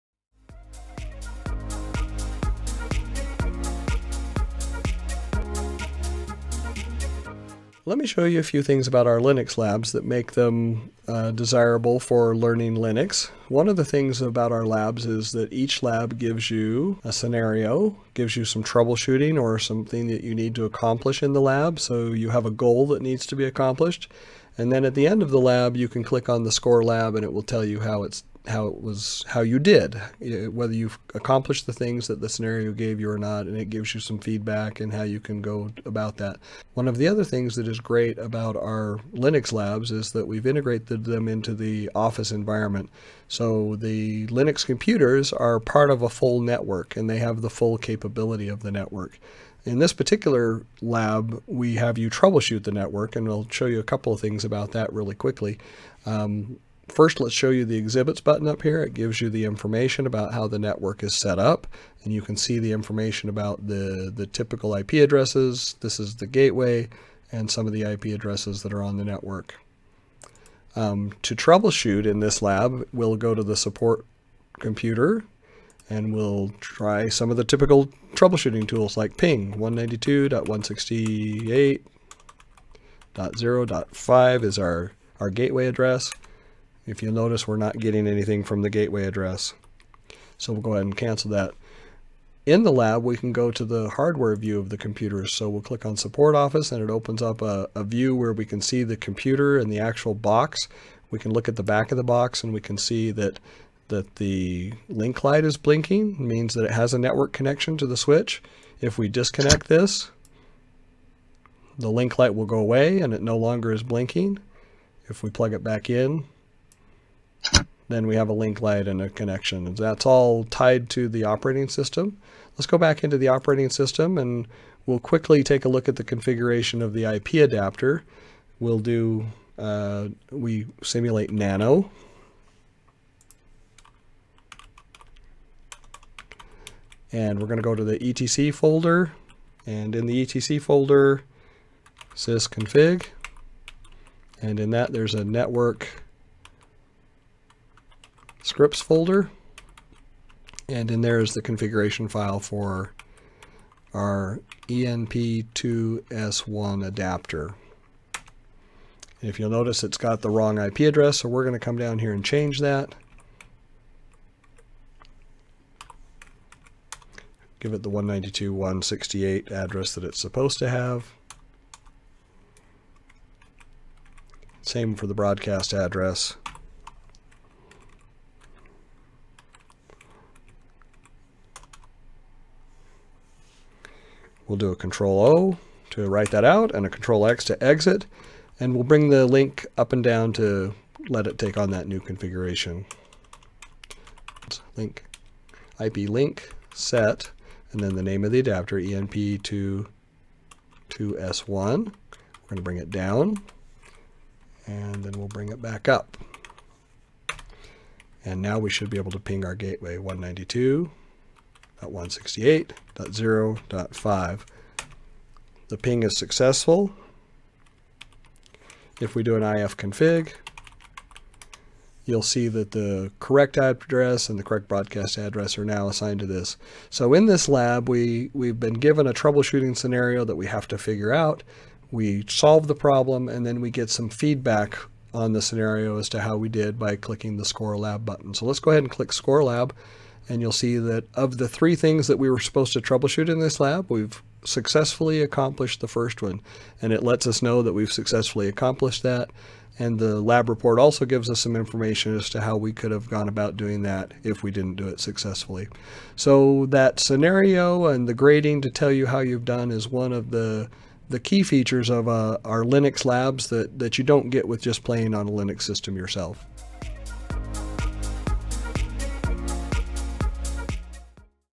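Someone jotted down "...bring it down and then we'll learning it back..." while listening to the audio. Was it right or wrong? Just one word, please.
wrong.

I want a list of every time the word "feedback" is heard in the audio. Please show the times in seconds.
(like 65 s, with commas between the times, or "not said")
34 s, 234 s.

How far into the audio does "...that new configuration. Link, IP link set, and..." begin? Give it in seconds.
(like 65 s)
191 s.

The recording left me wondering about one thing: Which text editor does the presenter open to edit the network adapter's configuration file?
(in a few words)
nano.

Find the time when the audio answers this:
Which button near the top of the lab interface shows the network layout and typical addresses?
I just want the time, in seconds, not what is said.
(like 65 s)
57 s.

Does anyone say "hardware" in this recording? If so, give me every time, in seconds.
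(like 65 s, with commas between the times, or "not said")
93 s.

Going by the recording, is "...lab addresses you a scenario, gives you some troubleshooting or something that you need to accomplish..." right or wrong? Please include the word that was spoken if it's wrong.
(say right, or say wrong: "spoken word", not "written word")
wrong: "gives", not "addresses".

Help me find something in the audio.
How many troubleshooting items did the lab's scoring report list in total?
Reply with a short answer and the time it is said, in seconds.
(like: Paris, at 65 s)
3, at 241 s.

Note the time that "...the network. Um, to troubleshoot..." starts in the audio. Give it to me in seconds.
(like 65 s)
68 s.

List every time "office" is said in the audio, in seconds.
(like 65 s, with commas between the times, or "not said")
41 s, 96 s.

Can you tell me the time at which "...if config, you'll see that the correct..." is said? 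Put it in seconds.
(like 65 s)
219 s.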